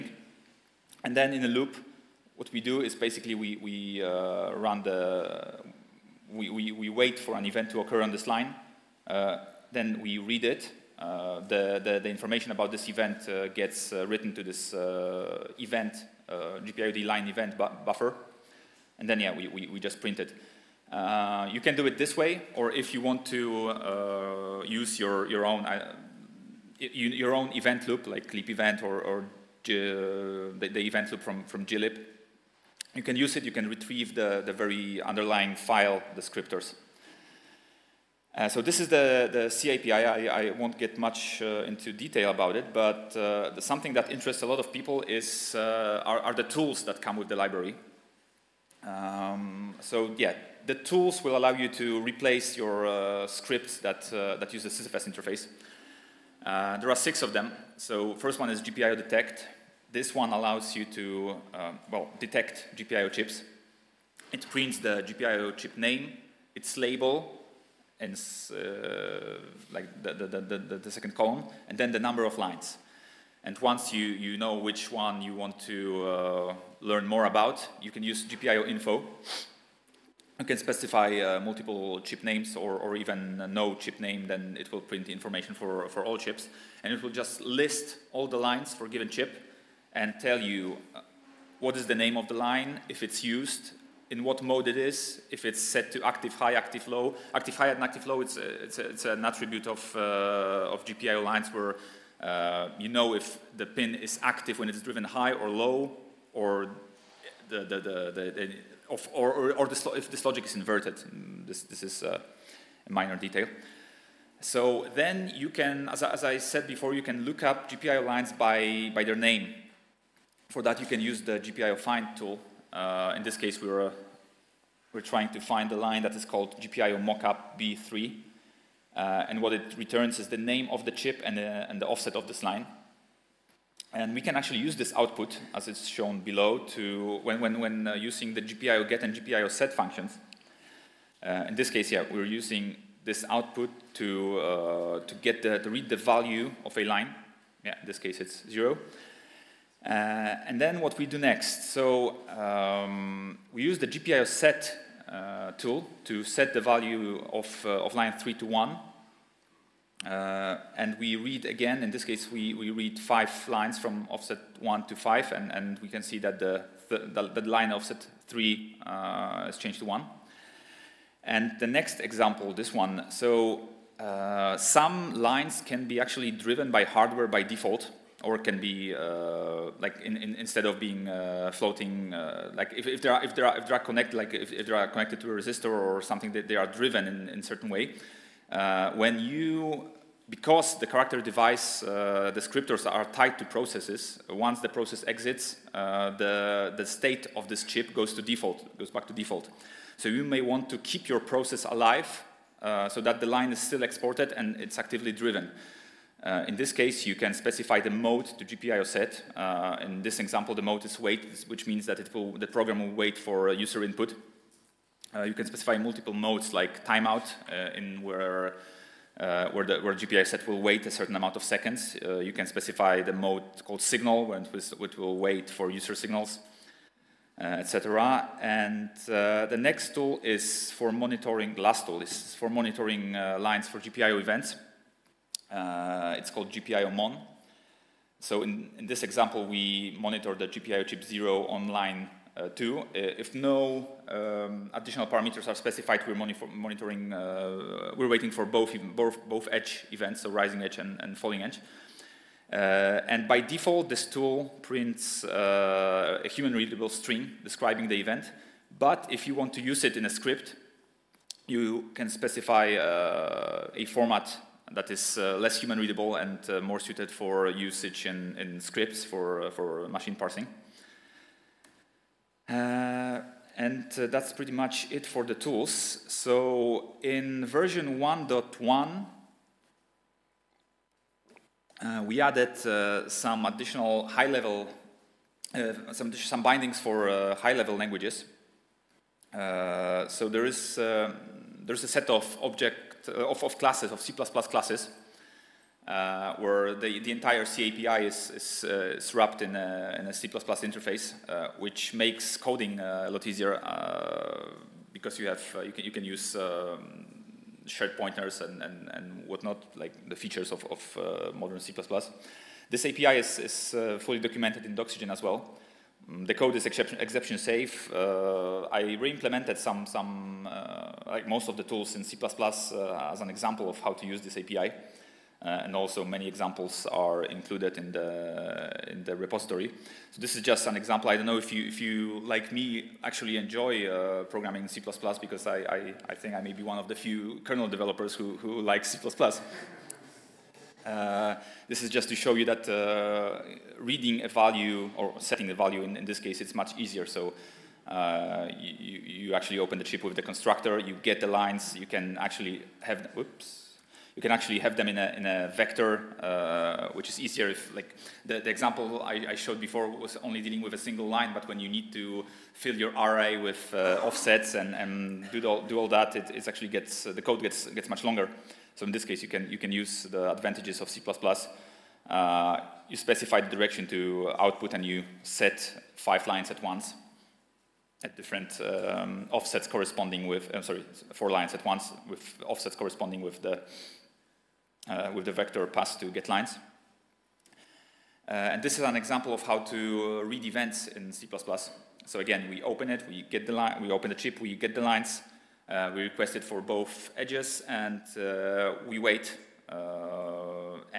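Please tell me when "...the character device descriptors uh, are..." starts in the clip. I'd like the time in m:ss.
3:10.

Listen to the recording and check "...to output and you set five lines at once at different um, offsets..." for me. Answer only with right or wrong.
right.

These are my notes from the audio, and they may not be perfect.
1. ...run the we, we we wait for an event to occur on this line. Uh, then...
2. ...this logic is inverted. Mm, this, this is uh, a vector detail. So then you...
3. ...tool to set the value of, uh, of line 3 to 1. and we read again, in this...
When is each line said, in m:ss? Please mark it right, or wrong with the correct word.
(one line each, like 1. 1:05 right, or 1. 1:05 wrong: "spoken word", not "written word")
1. 0:04 right
2. 1:50 wrong: "minor", not "vector"
3. 2:35 right.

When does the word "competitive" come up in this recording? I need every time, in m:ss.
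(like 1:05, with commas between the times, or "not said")
not said.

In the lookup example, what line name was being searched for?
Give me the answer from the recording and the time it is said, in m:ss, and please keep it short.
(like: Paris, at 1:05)
GPIO mockup B3, at 2:06.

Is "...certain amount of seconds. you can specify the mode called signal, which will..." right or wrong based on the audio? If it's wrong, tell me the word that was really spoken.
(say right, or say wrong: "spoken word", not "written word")
right.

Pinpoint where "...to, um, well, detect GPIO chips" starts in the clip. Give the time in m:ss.
1:00.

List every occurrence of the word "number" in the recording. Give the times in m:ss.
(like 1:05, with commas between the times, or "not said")
1:11.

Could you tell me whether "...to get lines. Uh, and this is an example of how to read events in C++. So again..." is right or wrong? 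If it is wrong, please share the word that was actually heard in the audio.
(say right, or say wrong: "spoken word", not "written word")
right.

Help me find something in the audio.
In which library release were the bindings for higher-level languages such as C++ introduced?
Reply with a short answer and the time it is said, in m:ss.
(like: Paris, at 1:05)
1.1, at 4:37.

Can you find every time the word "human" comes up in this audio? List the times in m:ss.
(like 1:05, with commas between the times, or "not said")
4:16, 4:25.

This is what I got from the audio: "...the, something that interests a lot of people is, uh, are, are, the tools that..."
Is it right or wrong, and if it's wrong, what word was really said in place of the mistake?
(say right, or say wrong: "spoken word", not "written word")
right.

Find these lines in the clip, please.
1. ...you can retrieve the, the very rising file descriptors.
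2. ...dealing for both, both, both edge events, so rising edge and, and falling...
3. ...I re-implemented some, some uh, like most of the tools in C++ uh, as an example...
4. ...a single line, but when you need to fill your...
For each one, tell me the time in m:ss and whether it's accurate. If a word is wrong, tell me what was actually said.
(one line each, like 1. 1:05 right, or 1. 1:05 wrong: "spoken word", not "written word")
1. 0:33 wrong: "underlying", not "rising"
2. 4:08 wrong: "waiting", not "dealing"
3. 5:18 right
4. 6:00 right.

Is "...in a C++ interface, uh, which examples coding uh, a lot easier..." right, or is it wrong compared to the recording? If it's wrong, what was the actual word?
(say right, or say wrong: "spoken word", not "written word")
wrong: "makes", not "examples".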